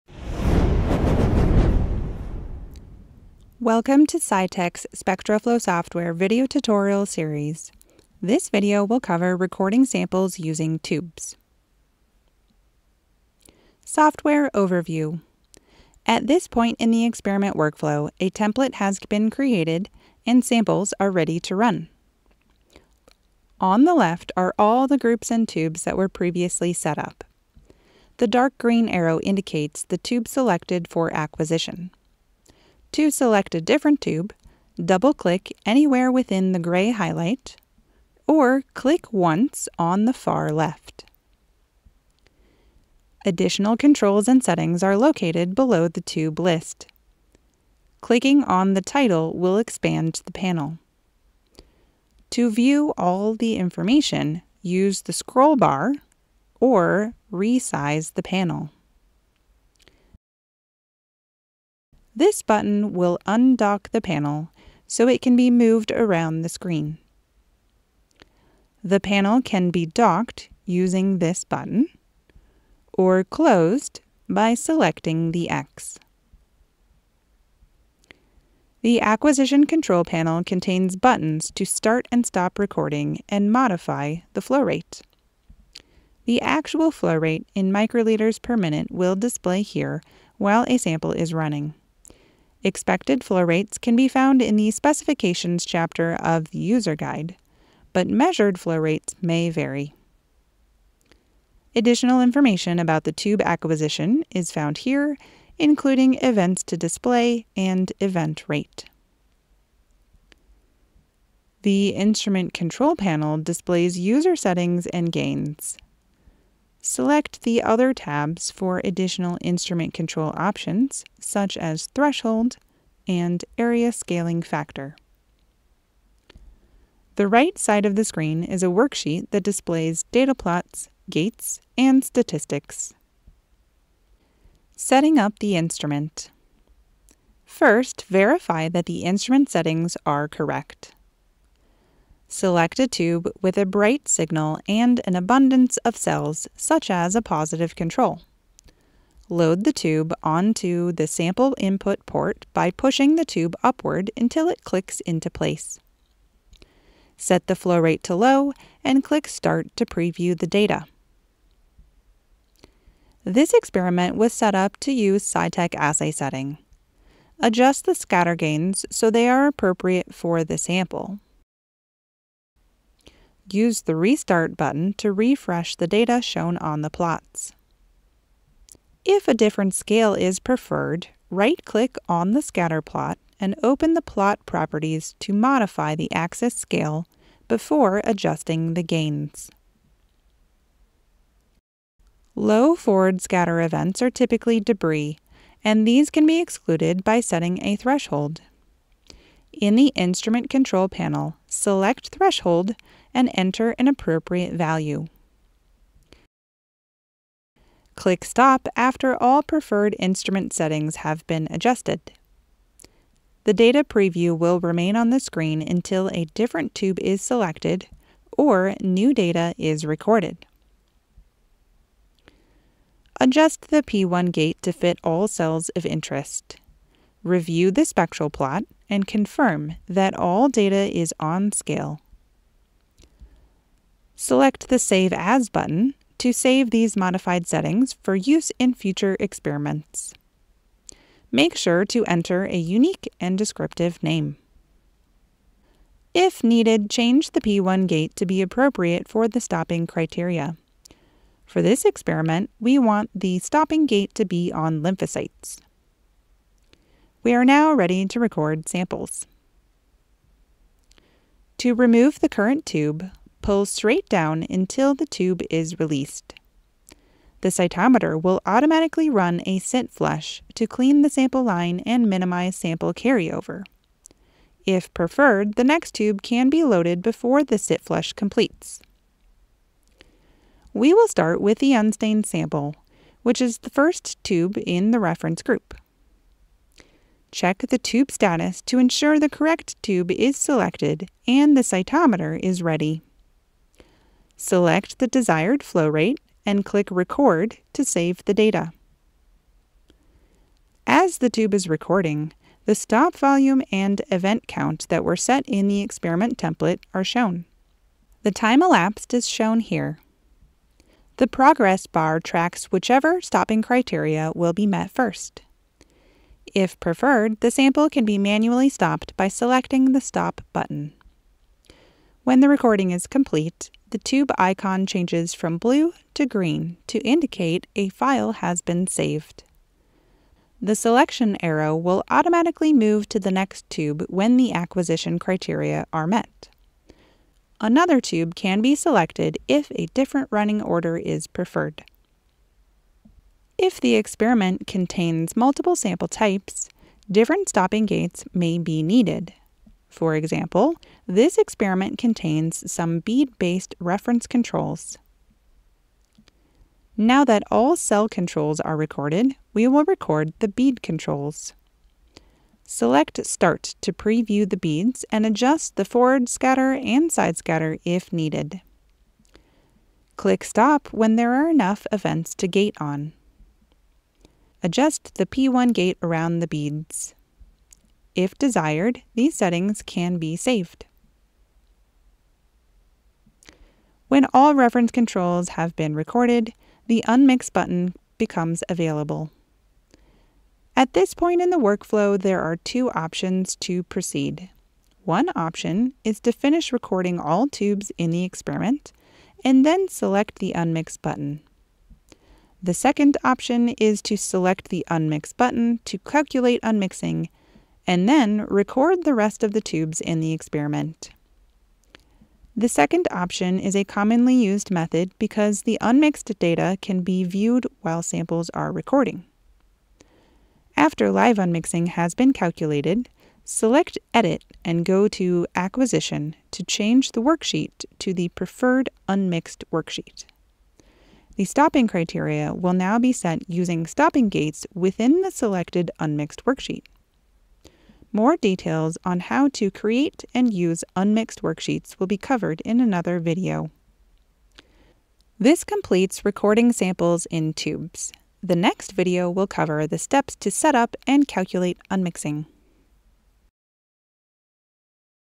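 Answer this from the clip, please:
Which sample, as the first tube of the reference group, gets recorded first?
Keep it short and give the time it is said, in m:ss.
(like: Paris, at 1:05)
Unstained sample, at 4:41.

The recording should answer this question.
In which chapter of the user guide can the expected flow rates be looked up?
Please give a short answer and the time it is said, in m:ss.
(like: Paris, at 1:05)
Specifications, at 1:34.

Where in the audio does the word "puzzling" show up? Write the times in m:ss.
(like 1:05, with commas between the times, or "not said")
not said.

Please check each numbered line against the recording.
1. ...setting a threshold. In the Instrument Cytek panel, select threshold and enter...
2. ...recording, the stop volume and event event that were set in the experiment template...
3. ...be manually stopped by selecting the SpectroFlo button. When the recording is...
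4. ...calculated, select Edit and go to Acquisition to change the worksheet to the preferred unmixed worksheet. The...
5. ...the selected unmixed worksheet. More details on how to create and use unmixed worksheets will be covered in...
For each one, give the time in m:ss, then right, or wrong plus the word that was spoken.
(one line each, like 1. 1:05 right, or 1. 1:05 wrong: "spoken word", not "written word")
1. 3:17 wrong: "Control", not "Cytek"
2. 5:01 wrong: "count", not "event"
3. 5:18 wrong: "Stop", not "SpectroFlo"
4. 7:02 right
5. 7:15 right.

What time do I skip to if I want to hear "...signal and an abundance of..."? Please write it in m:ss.
2:24.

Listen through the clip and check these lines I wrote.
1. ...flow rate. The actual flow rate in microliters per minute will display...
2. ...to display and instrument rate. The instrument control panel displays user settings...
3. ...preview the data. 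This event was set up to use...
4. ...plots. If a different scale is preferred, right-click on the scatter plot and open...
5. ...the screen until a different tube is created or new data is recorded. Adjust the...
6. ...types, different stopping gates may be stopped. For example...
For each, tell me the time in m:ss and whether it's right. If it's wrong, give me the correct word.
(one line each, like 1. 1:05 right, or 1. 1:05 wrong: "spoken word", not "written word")
1. 1:24 right
2. 1:46 wrong: "event", not "instrument"
3. 2:39 wrong: "experiment", not "event"
4. 2:56 right
5. 3:35 wrong: "selected", not "created"
6. 5:46 wrong: "needed", not "stopped".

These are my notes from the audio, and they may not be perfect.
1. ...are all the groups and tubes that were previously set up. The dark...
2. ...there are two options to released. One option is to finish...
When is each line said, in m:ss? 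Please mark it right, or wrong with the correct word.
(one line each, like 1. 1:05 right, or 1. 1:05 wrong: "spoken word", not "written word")
1. 0:24 right
2. 6:32 wrong: "proceed", not "released".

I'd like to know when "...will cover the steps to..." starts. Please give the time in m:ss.
7:29.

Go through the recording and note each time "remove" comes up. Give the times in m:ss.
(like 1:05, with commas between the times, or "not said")
4:21.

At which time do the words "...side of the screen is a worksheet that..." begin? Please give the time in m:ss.
2:07.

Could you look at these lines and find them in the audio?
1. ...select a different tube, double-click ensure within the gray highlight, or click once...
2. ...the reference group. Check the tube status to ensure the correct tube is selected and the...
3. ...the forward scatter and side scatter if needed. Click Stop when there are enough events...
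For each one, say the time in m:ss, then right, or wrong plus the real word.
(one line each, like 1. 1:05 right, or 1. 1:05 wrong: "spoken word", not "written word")
1. 0:33 wrong: "anywhere", not "ensure"
2. 4:44 right
3. 6:05 right.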